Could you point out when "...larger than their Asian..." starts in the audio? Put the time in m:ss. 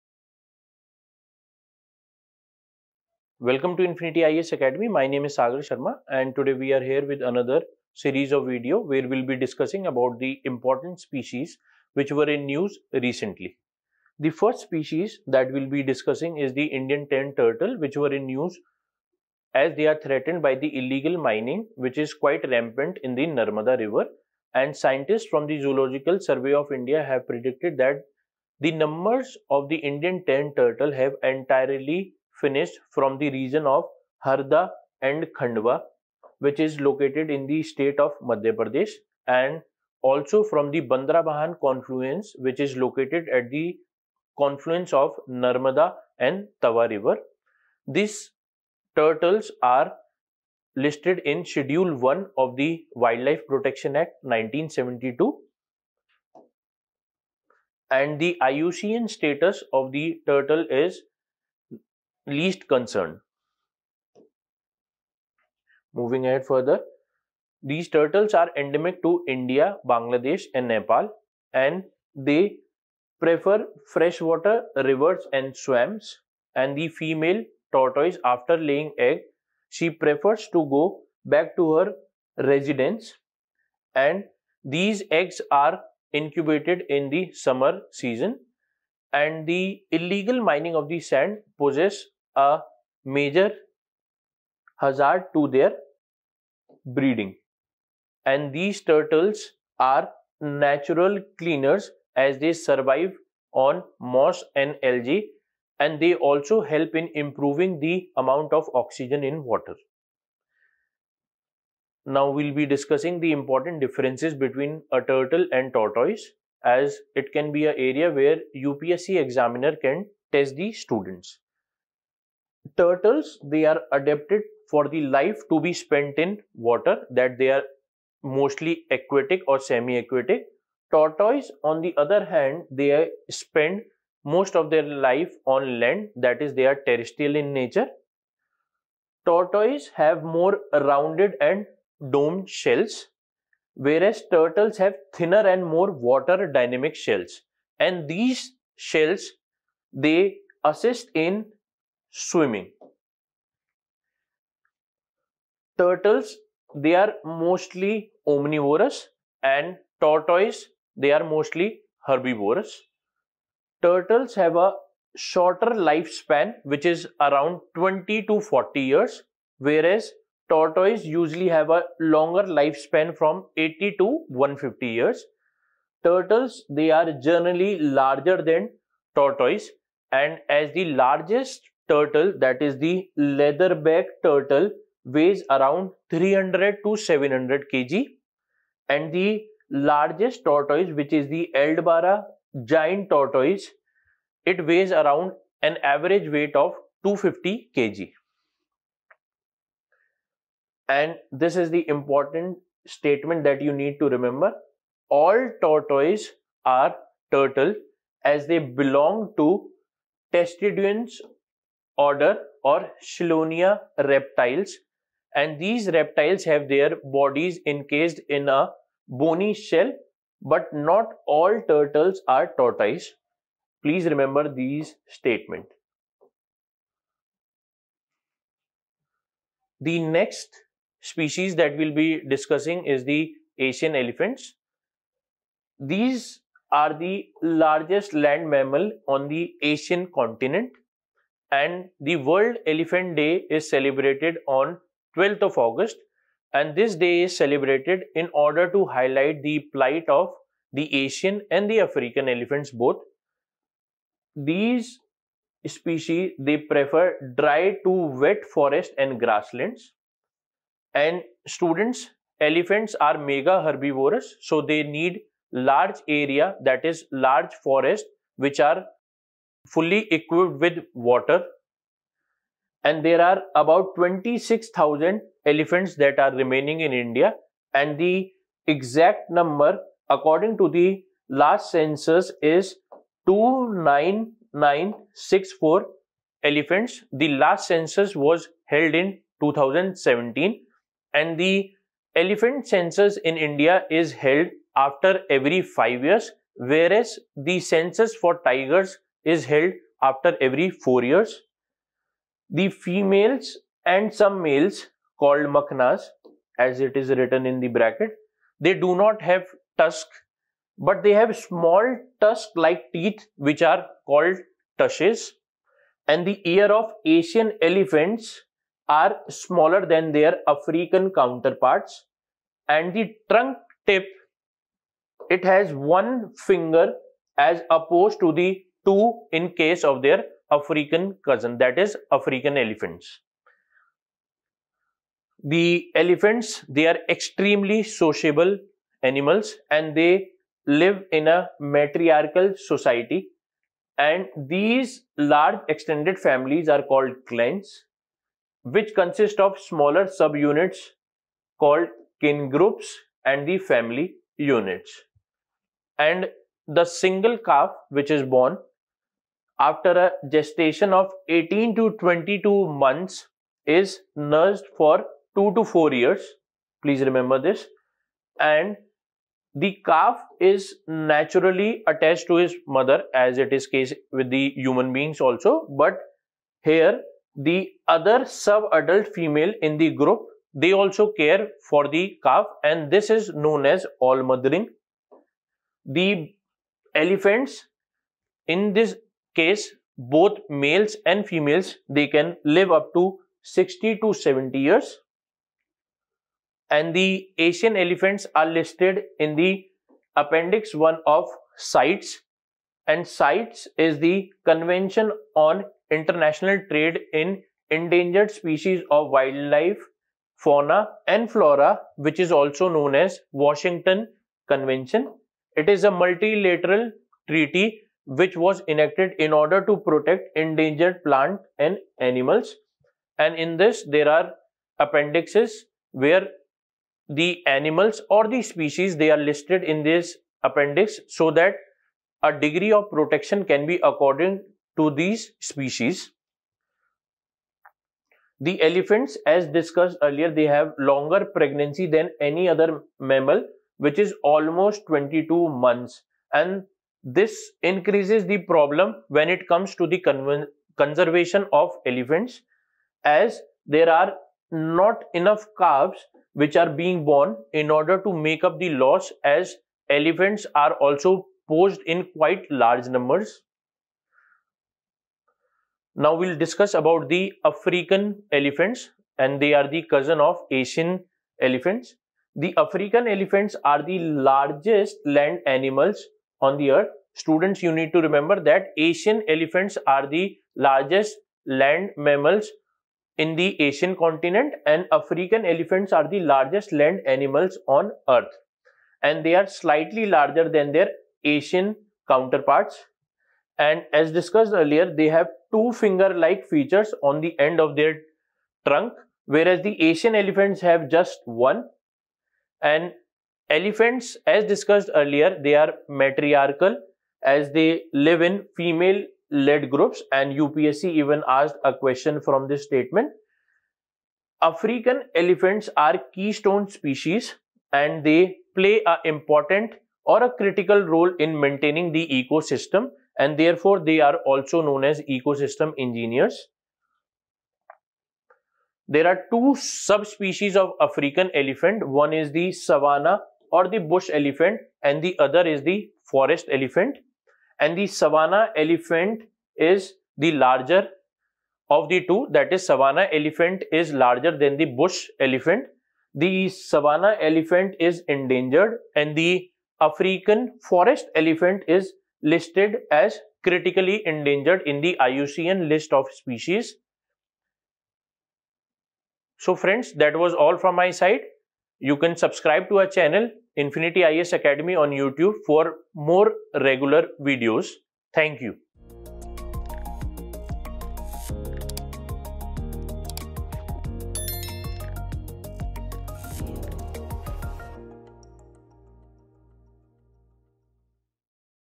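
8:10.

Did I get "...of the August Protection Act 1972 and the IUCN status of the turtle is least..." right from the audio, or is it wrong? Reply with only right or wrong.
wrong.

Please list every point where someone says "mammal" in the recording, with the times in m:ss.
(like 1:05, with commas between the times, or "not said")
3:58, 7:22, 8:01.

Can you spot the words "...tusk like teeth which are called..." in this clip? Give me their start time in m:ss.
5:12.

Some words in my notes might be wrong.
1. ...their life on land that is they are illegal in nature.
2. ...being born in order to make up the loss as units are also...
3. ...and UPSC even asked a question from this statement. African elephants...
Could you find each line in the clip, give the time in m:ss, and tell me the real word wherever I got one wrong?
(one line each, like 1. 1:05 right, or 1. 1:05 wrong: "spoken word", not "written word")
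1. 2:14 wrong: "terrestrial", not "illegal"
2. 7:36 wrong: "elephants", not "units"
3. 8:30 right.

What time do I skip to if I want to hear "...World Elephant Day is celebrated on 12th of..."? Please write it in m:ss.
4:02.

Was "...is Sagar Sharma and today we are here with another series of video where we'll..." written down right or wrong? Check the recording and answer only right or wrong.
right.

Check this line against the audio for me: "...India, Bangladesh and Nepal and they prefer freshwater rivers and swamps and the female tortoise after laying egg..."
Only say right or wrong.
right.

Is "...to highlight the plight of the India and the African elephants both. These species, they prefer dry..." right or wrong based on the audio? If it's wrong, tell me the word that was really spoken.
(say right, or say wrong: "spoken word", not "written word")
wrong: "Asian", not "India".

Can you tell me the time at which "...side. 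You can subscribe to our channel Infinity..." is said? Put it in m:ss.
9:20.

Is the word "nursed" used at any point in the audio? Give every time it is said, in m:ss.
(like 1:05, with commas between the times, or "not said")
6:04.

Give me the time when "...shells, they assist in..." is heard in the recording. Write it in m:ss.
2:28.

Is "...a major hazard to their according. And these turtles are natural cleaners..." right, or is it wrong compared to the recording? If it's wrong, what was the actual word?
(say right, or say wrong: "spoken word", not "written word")
wrong: "breeding", not "according".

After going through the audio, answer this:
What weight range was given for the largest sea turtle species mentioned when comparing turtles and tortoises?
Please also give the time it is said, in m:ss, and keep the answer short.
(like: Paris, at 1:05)
300 to 700 kg, at 3:06.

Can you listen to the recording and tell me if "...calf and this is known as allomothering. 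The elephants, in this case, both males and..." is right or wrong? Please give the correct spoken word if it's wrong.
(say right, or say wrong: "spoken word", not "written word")
right.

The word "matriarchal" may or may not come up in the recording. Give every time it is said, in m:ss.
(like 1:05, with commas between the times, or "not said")
5:41, 8:26.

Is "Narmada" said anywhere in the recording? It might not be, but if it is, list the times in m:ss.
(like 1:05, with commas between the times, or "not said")
0:23, 0:45.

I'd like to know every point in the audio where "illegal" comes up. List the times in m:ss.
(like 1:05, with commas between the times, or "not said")
0:20, 1:29.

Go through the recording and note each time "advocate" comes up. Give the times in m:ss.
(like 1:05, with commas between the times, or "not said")
not said.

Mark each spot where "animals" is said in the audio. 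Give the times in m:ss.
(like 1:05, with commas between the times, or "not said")
5:39, 7:01, 7:07, 7:55, 8:07.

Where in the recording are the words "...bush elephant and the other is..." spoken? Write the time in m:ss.
8:53.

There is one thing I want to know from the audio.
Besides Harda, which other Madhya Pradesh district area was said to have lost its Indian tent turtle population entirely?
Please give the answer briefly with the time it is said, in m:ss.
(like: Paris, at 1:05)
Khandwa, at 0:35.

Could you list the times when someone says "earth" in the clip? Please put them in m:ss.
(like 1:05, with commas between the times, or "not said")
7:56, 8:08.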